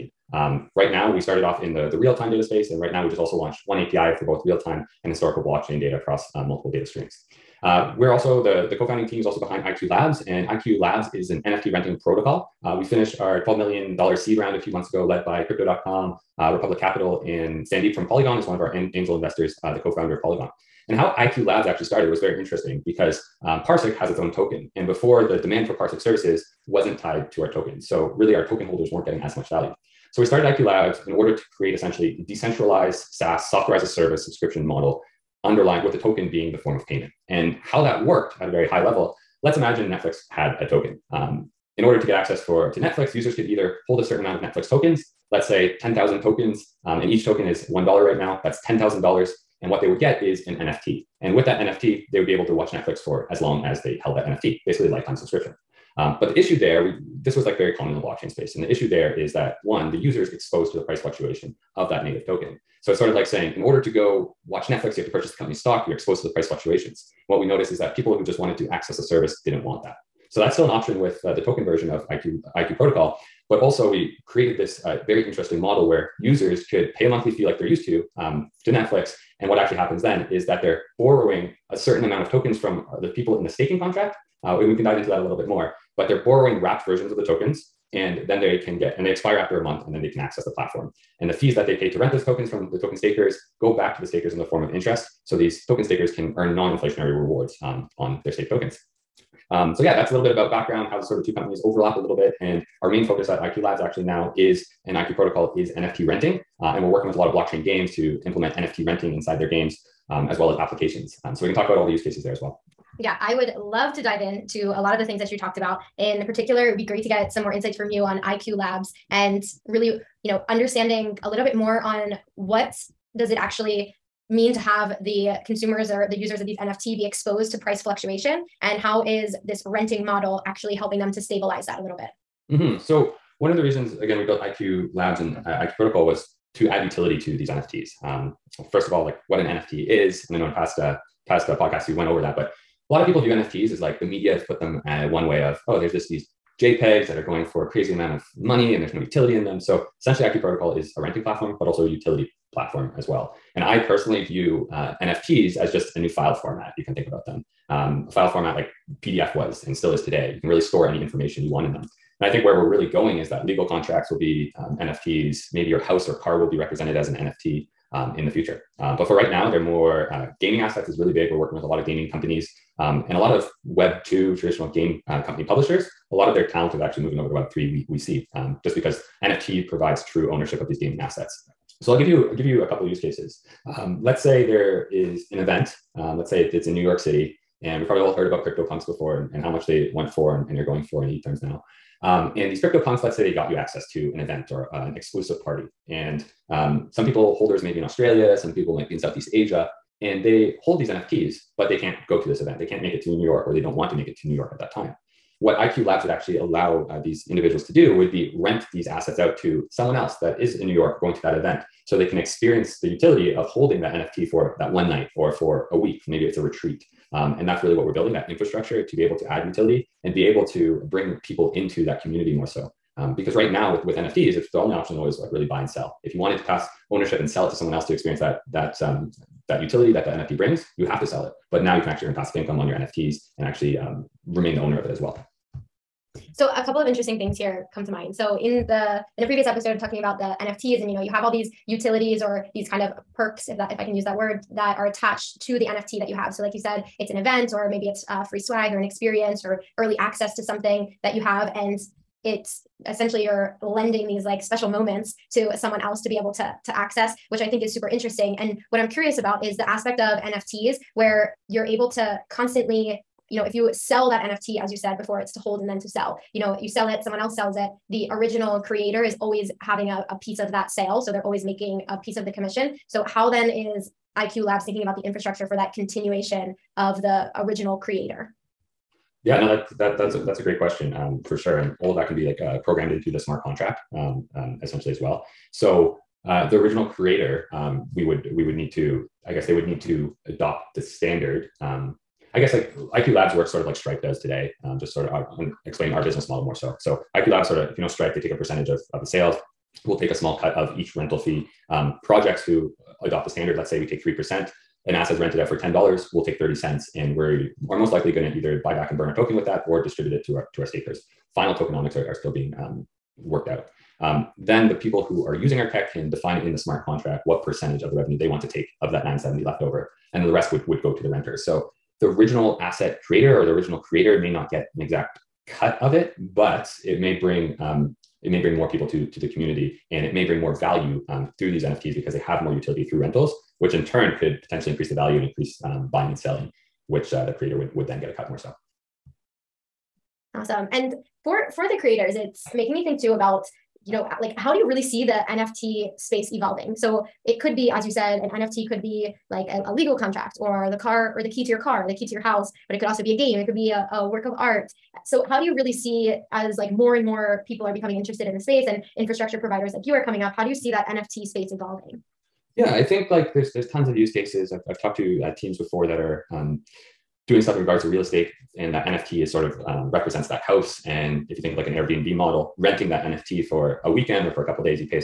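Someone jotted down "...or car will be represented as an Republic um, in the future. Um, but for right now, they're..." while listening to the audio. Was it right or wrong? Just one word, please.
wrong.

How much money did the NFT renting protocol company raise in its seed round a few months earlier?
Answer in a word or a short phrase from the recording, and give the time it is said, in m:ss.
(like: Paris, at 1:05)
$12 million, at 0:13.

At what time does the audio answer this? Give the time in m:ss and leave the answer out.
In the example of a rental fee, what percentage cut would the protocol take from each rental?
5:04.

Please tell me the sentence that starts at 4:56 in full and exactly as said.
So IQ Labs sort of, if you know Stripe, they take a percentage of, of the sales.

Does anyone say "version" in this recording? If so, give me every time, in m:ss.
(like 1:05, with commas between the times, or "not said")
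1:11, 1:26.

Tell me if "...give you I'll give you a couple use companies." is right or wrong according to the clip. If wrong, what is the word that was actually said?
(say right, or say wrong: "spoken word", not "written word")
wrong: "cases", not "companies".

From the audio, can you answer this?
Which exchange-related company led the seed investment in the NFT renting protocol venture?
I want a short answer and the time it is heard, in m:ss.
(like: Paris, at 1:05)
Crypto.com, at 0:15.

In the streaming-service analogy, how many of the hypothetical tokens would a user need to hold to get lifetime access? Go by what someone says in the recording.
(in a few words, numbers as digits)
10,000.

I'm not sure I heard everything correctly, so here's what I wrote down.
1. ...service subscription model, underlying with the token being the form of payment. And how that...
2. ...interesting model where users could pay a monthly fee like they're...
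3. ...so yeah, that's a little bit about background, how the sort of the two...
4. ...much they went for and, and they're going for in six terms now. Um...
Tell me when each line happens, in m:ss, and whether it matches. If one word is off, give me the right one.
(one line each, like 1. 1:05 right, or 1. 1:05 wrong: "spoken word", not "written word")
1. 0:33 right
2. 1:15 right
3. 1:39 right
4. 3:09 wrong: "eight", not "six".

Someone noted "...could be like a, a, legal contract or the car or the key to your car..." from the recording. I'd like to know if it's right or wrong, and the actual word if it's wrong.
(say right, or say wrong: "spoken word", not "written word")
right.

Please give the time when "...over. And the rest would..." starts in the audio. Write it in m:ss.
5:19.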